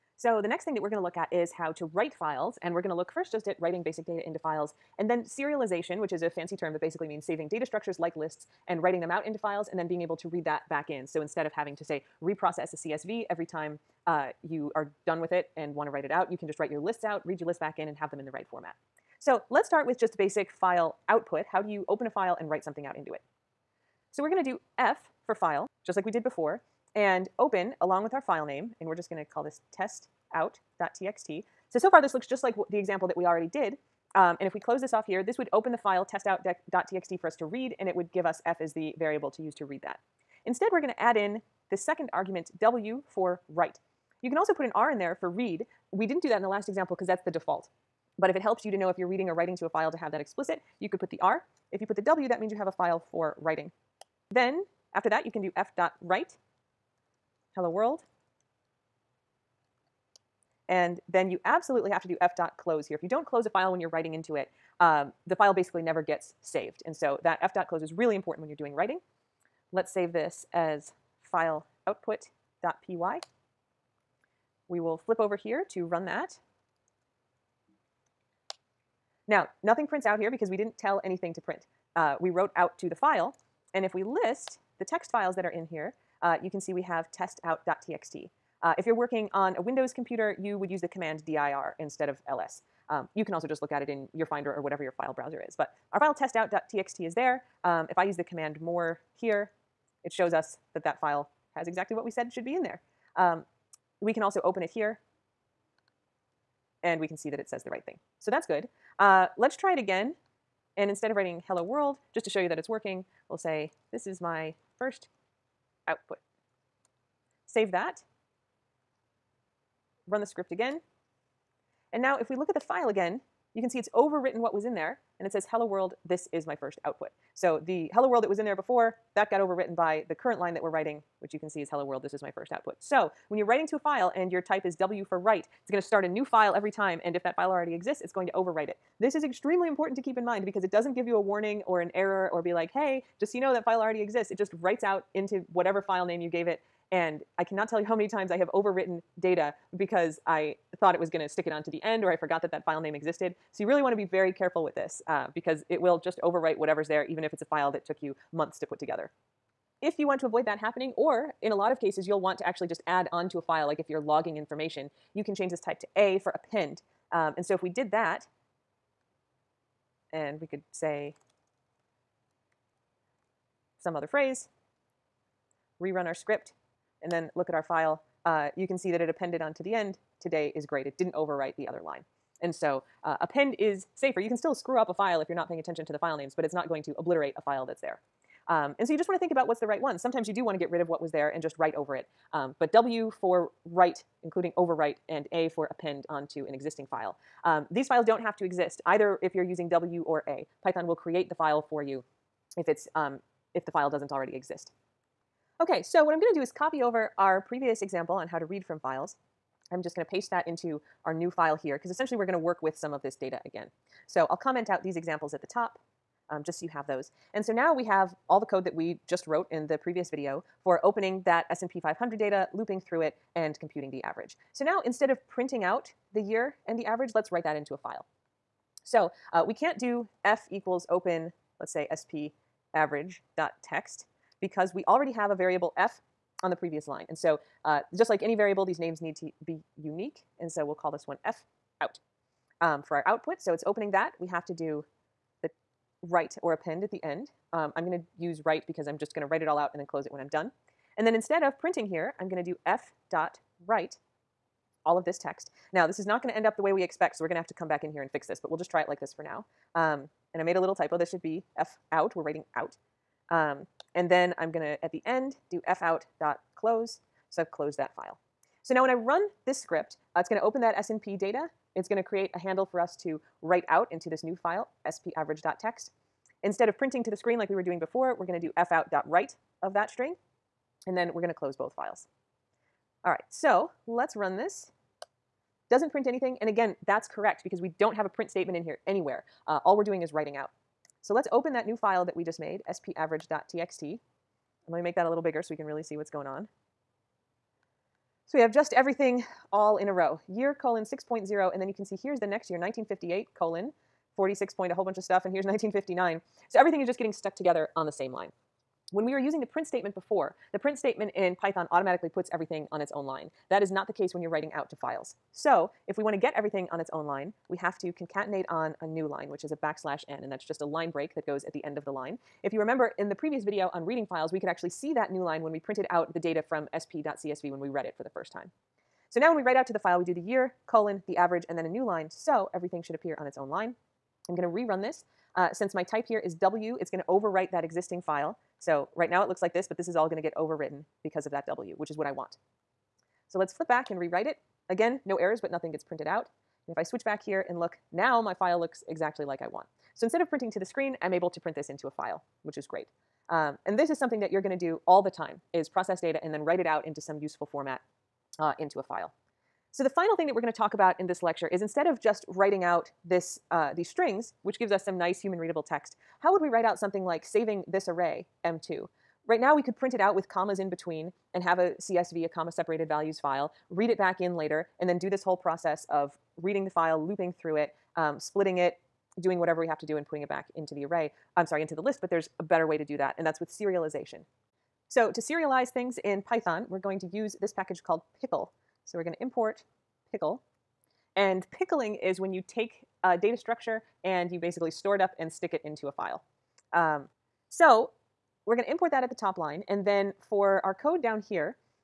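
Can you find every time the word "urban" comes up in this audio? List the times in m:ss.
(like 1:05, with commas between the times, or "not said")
not said.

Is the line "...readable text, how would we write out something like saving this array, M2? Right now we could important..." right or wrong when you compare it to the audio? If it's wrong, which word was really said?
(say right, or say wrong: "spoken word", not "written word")
wrong: "print", not "important".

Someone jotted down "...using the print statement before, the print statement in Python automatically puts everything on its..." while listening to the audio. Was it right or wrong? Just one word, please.
right.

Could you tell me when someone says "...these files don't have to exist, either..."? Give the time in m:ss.
3:17.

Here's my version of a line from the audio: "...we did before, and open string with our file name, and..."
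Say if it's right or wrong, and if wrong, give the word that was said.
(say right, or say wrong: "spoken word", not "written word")
wrong: "along", not "string".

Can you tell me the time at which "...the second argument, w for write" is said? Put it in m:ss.
0:41.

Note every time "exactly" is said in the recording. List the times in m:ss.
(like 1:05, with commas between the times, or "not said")
1:41, 5:48.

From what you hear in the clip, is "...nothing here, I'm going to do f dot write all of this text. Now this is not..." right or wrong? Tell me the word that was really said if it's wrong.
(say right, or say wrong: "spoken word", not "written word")
wrong: "printing", not "nothing".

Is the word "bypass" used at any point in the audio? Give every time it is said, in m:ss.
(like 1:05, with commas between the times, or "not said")
not said.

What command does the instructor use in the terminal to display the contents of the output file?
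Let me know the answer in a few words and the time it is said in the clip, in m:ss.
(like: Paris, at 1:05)
more, at 1:38.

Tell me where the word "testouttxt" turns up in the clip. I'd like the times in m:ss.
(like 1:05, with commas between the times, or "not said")
0:29, 0:36, 1:27, 1:36.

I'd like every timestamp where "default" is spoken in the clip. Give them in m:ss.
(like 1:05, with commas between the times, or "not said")
0:47.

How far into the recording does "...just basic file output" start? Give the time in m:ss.
0:19.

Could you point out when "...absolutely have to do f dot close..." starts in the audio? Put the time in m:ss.
1:01.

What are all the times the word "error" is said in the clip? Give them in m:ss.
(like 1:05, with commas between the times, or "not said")
2:21, 5:45.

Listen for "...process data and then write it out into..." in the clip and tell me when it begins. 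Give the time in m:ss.
5:55.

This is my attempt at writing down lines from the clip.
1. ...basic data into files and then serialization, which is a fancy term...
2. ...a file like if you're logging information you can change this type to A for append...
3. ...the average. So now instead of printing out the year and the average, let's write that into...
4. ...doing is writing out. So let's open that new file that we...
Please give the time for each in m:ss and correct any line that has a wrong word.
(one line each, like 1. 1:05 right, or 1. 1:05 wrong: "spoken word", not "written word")
1. 0:03 right
2. 2:43 right
3. 3:43 right
4. 4:49 right.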